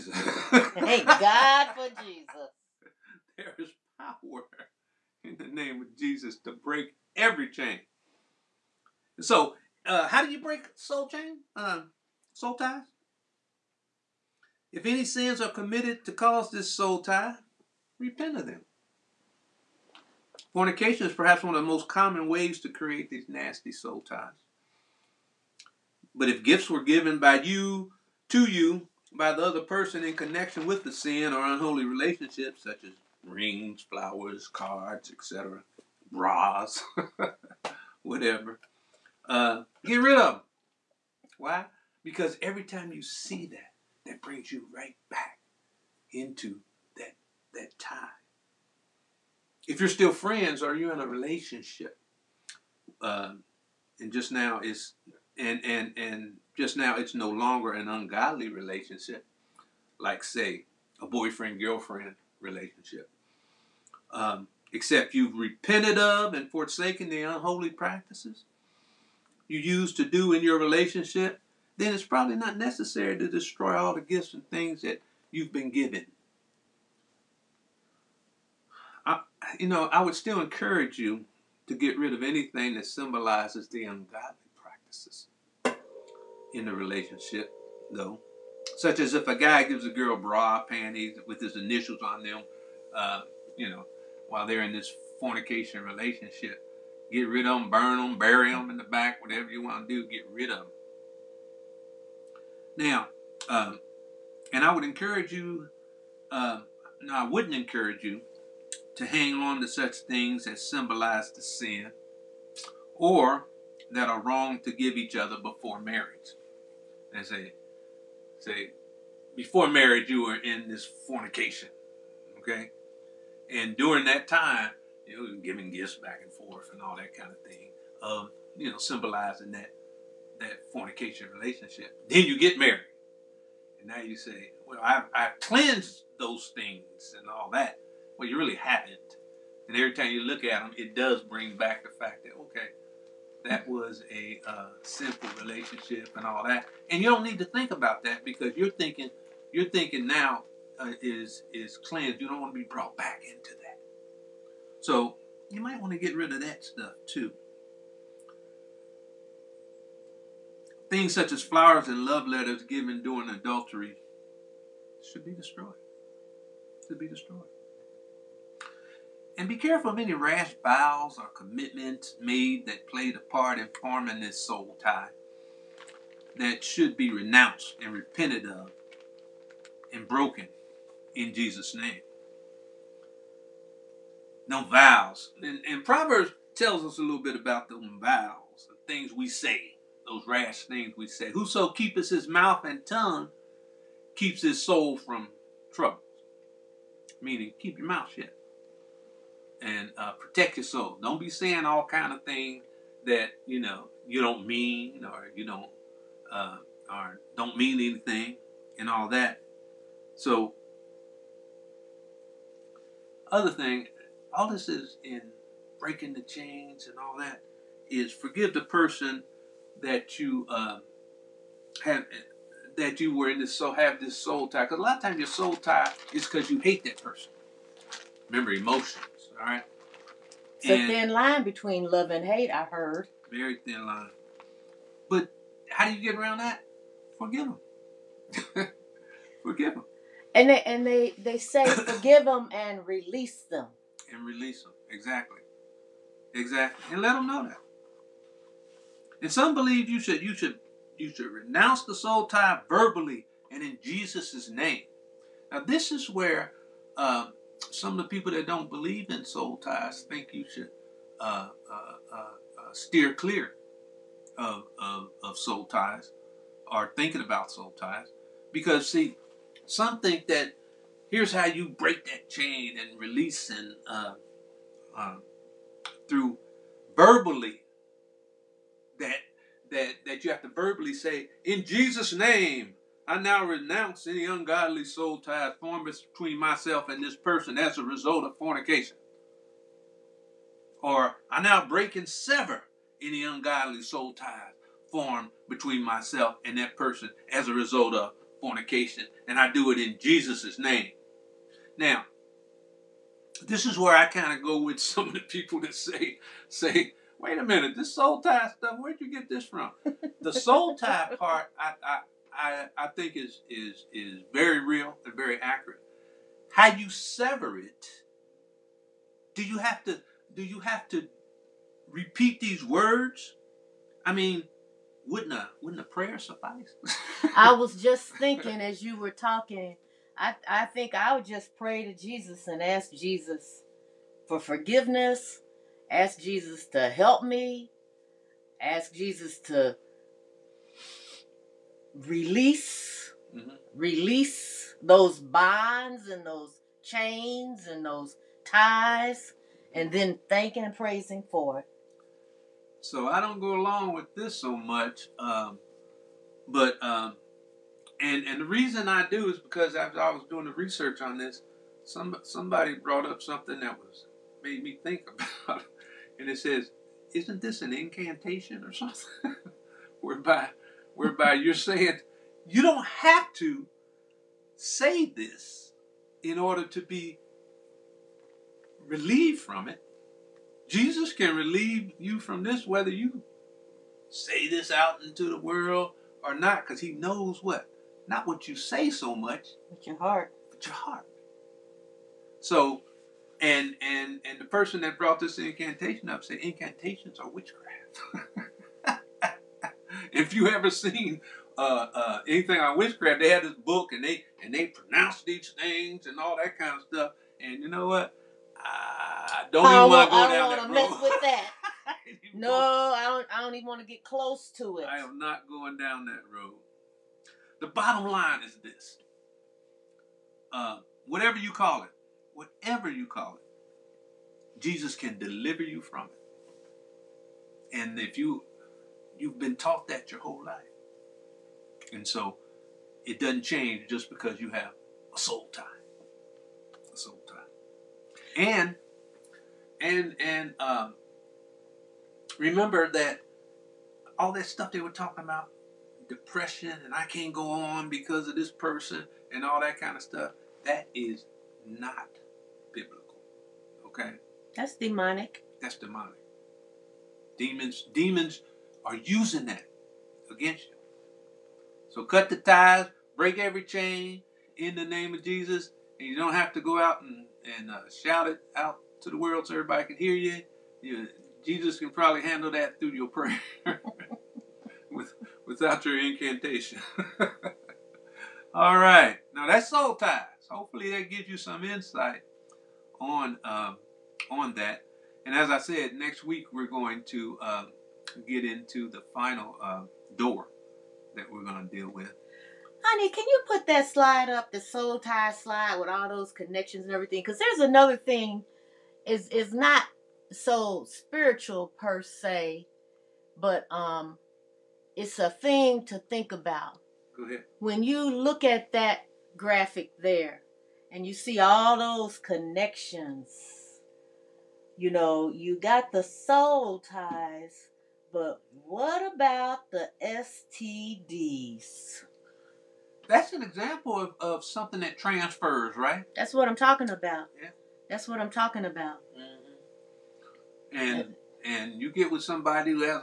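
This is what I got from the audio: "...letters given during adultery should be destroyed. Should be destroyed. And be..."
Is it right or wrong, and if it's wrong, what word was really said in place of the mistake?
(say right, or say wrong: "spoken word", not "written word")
right.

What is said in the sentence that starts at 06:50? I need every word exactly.
I don't want to mess with that.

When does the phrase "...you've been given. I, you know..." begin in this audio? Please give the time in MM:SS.
01:15.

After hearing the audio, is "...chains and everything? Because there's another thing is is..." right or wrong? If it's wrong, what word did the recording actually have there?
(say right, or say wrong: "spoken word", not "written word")
wrong: "connections", not "chains".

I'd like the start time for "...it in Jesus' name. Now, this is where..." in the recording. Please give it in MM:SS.
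04:59.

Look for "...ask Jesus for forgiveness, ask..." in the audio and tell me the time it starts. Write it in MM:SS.
05:32.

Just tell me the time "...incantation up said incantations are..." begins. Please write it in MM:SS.
06:35.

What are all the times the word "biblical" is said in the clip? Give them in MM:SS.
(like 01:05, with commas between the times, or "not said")
07:32.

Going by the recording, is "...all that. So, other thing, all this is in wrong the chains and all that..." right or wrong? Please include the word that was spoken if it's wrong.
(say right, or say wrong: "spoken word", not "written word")
wrong: "breaking", not "wrong".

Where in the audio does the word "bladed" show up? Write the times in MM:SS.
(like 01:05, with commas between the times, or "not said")
not said.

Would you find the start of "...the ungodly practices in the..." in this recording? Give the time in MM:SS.
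01:23.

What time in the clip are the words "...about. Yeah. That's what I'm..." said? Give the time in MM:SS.
08:46.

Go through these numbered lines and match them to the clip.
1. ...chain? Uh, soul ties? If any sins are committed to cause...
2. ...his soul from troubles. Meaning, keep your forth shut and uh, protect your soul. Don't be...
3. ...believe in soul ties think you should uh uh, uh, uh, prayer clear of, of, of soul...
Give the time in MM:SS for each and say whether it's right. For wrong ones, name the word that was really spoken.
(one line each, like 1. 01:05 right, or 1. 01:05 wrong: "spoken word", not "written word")
1. 00:11 right
2. 03:14 wrong: "mouth", not "forth"
3. 04:18 wrong: "steer", not "prayer".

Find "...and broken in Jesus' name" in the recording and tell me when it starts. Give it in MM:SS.
02:59.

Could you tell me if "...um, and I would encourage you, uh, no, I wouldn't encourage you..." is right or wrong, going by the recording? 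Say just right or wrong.
right.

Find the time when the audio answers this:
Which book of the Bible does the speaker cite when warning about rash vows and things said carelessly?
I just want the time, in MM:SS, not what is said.
03:05.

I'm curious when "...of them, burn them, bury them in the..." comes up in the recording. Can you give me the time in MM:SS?
01:37.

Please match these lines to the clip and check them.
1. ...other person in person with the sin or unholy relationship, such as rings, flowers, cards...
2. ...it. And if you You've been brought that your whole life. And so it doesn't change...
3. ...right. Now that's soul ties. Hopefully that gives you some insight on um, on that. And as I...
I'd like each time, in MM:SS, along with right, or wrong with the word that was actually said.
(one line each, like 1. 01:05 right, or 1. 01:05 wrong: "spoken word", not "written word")
1. 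00:29 wrong: "connection", not "person"
2. 07:06 wrong: "taught", not "brought"
3. 07:58 right.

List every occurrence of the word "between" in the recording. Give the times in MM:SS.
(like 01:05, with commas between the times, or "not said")
03:51, 04:46, 04:55.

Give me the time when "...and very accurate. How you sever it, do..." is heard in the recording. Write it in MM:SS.
05:15.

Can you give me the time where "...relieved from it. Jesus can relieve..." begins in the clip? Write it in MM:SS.
06:18.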